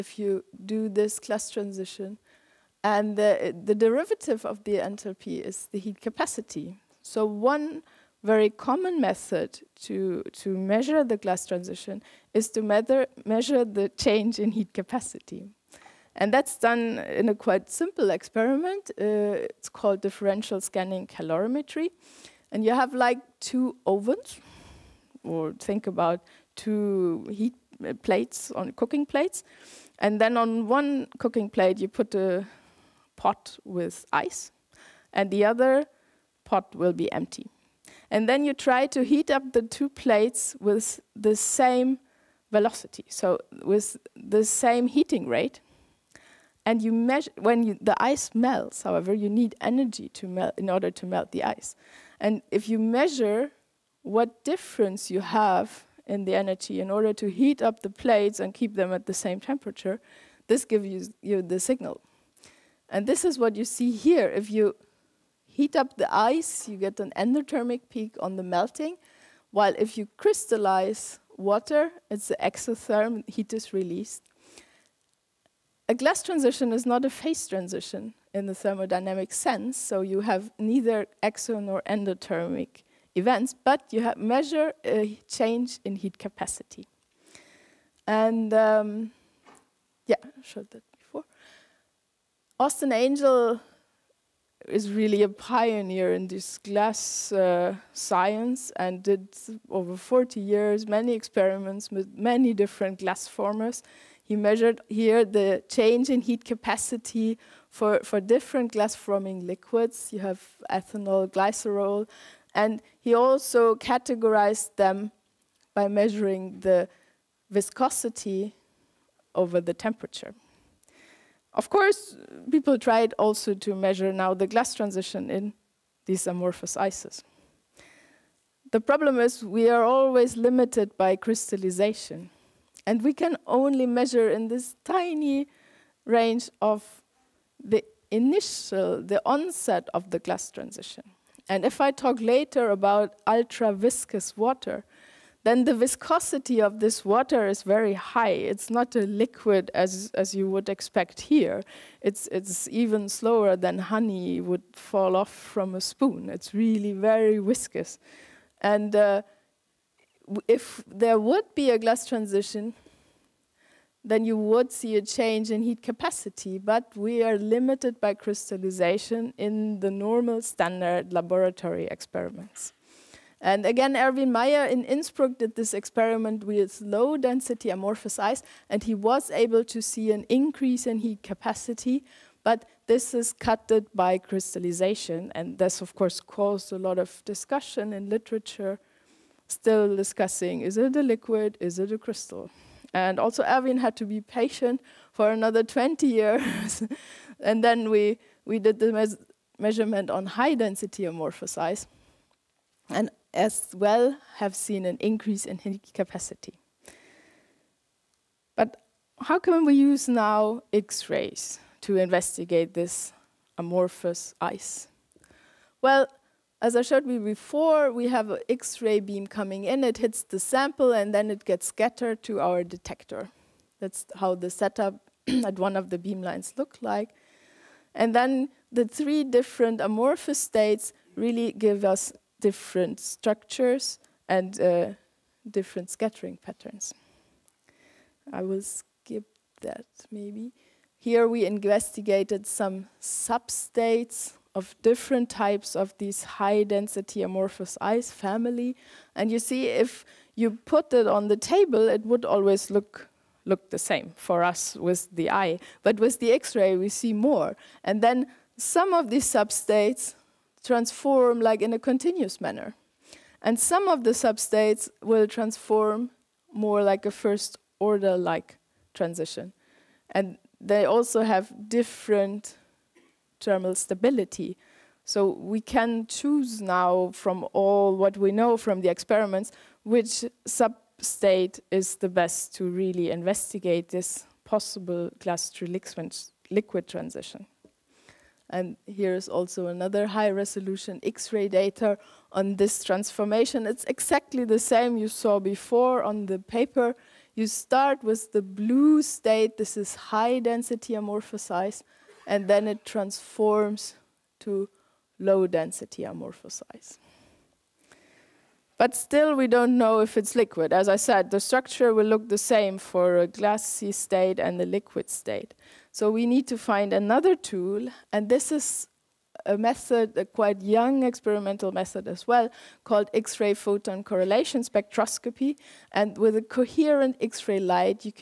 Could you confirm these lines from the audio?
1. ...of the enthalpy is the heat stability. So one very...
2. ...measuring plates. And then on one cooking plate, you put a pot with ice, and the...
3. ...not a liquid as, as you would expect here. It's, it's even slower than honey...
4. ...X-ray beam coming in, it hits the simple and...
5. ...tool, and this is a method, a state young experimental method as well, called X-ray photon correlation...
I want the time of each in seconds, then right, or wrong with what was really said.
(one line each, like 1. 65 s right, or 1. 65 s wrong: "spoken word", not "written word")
1. 4 s wrong: "capacity", not "stability"
2. 28 s wrong: "cooking", not "measuring"
3. 148 s right
4. 218 s wrong: "sample", not "simple"
5. 317 s wrong: "quite", not "state".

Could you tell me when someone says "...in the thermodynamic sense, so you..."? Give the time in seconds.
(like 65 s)
78 s.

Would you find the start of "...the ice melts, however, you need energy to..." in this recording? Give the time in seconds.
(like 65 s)
47 s.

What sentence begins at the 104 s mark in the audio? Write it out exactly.
He measured here the change in heat capacity for, for different glass forming liquids.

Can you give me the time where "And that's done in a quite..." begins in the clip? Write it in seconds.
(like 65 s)
16 s.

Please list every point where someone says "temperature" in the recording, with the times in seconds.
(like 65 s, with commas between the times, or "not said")
59 s, 119 s.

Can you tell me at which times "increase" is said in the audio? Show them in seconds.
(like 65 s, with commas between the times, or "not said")
180 s, 204 s.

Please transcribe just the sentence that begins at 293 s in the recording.
It's exactly the same you saw before on the paper.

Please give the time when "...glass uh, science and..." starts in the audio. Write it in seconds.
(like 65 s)
96 s.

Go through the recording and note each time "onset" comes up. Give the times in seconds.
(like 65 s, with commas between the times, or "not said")
139 s.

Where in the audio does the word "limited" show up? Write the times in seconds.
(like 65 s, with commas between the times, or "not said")
130 s, 167 s.